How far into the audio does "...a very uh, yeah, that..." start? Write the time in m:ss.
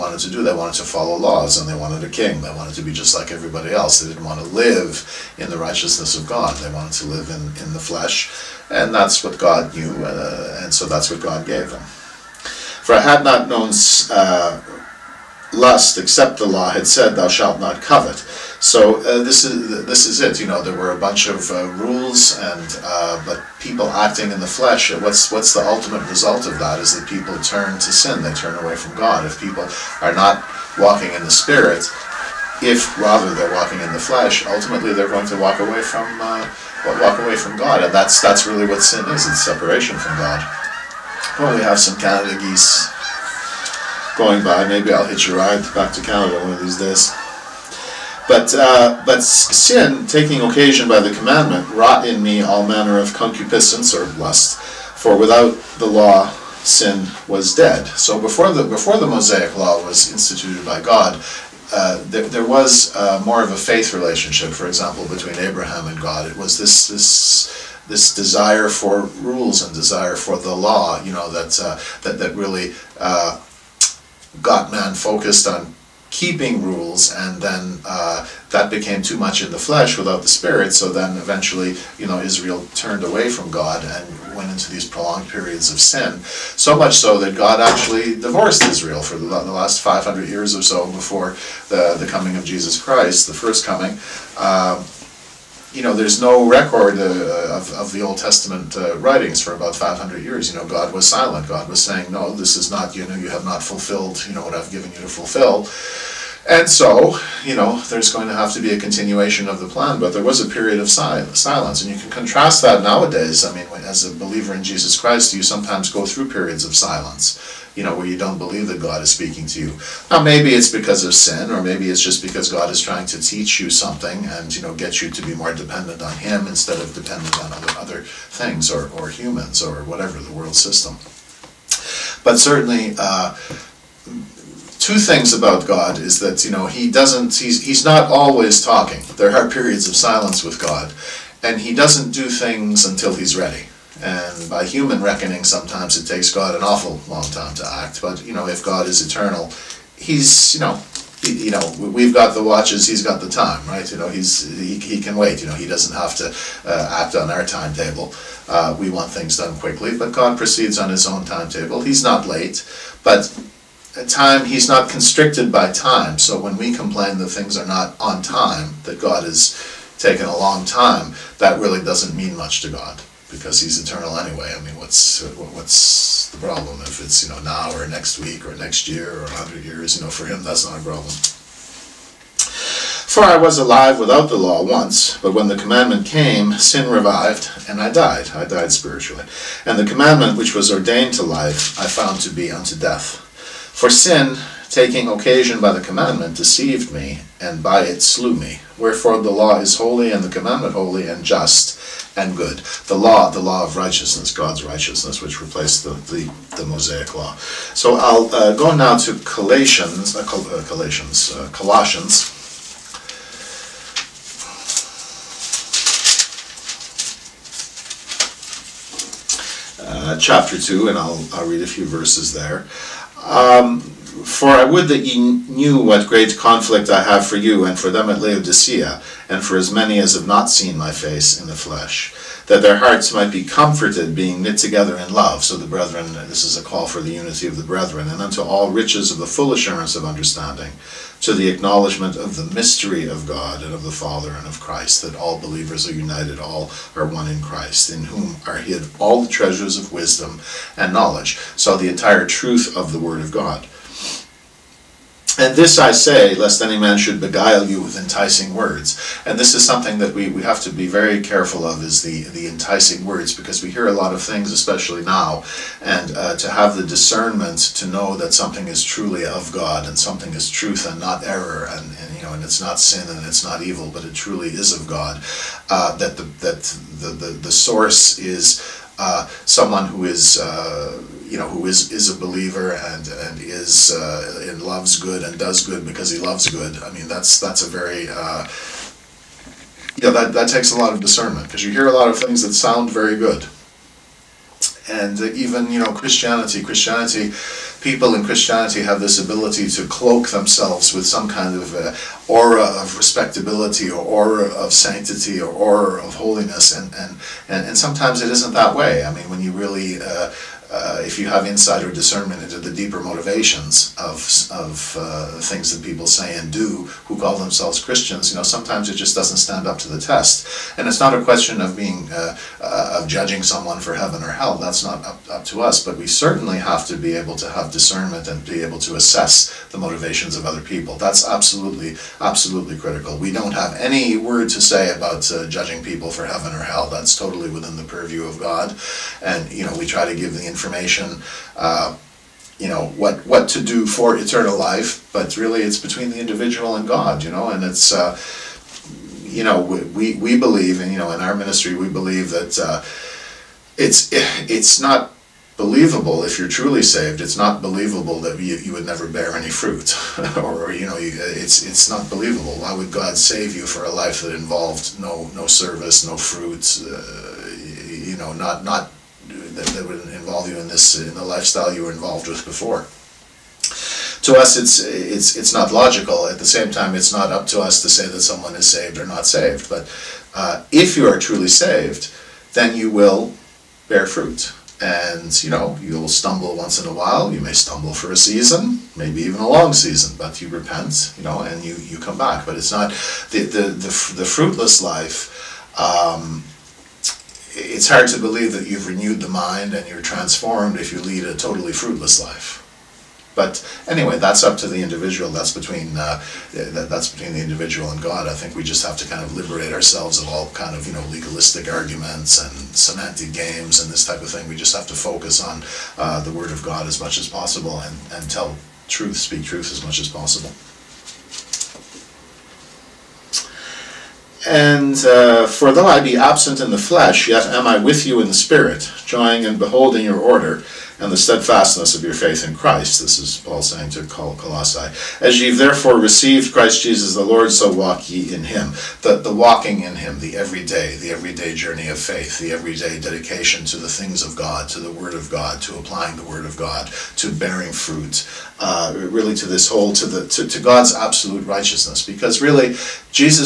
4:47.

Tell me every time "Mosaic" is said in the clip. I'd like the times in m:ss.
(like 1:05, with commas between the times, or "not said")
0:59, 3:26.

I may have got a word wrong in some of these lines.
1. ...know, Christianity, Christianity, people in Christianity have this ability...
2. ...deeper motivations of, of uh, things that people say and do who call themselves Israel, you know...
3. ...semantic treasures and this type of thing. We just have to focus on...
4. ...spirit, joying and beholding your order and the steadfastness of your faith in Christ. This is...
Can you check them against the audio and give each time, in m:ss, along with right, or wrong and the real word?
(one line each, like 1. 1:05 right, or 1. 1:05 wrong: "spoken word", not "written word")
1. 4:55 right
2. 5:12 wrong: "Christians", not "Israel"
3. 6:52 wrong: "games", not "treasures"
4. 7:08 right.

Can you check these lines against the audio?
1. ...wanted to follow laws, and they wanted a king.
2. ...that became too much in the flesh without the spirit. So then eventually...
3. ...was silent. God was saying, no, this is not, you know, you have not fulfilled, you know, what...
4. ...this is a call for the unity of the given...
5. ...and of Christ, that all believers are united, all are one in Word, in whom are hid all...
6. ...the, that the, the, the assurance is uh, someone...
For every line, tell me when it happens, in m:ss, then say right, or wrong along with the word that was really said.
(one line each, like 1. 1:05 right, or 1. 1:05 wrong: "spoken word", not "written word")
1. 0:00 right
2. 1:18 right
3. 1:40 right
4. 3:56 wrong: "brethren", not "given"
5. 4:04 wrong: "Christ", not "Word"
6. 4:36 wrong: "source", not "assurance".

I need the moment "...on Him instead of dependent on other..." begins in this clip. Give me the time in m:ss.
2:06.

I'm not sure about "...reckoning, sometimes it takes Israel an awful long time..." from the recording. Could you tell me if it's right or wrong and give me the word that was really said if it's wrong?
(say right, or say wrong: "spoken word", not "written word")
wrong: "God", not "Israel".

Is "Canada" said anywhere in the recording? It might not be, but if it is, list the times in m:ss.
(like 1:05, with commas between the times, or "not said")
0:41, 0:46.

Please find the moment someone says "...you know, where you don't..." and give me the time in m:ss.
1:57.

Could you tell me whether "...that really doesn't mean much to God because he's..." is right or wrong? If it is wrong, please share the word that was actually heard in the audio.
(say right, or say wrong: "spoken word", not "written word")
right.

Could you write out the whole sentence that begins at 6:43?
But anyway, that's up to the individual.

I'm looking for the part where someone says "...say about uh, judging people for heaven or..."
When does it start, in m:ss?
5:34.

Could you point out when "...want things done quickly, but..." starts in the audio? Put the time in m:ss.
2:38.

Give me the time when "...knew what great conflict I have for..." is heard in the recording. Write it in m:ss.
3:45.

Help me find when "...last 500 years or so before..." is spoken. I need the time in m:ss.
1:29.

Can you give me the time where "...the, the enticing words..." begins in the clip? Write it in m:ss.
4:22.